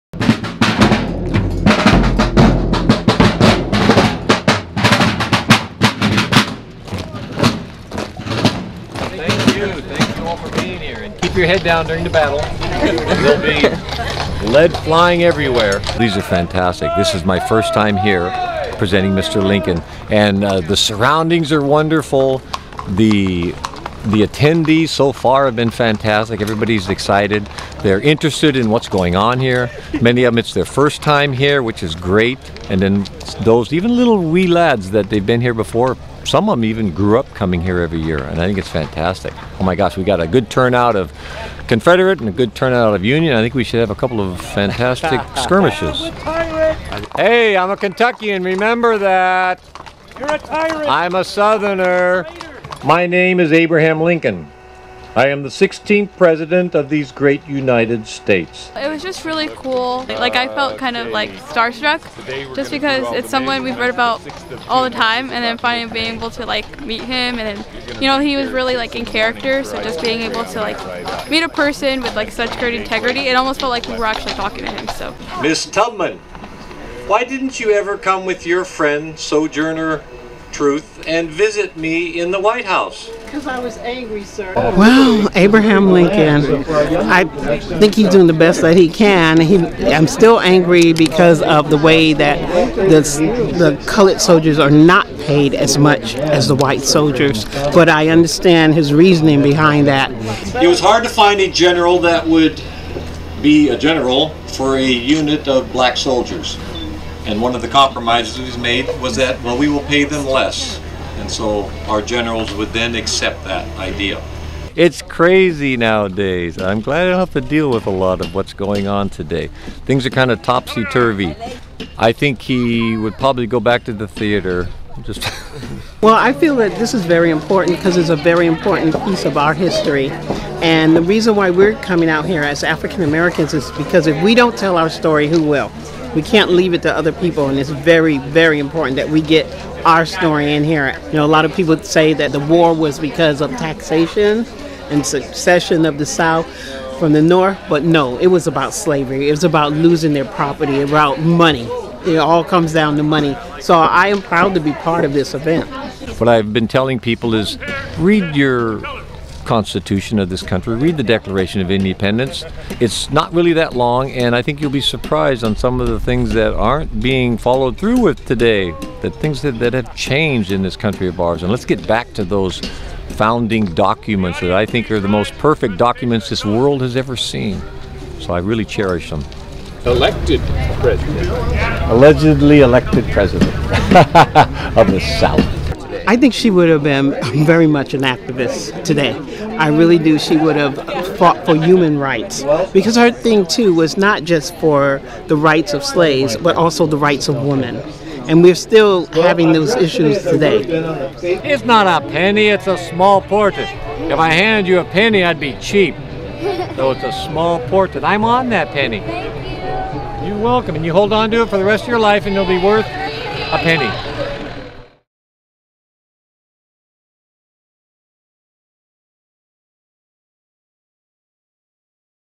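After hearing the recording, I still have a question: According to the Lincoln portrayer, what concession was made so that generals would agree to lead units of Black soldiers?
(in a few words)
Pay them less.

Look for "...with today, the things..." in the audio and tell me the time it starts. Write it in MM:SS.
02:47.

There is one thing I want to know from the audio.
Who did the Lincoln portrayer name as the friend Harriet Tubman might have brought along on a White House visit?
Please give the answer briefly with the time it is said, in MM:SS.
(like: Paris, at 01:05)
Sojourner Truth, at 01:19.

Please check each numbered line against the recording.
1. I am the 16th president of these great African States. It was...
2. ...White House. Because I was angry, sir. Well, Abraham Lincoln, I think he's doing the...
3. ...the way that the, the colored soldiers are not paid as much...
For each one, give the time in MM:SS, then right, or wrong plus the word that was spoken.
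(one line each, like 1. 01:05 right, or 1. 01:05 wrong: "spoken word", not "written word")
1. 00:55 wrong: "United", not "African"
2. 01:22 right
3. 01:31 right.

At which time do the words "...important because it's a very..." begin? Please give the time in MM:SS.
02:07.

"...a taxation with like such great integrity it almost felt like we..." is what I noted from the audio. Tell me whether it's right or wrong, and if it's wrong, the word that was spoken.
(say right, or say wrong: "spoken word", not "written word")
wrong: "person", not "taxation".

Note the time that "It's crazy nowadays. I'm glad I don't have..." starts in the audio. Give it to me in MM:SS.
01:54.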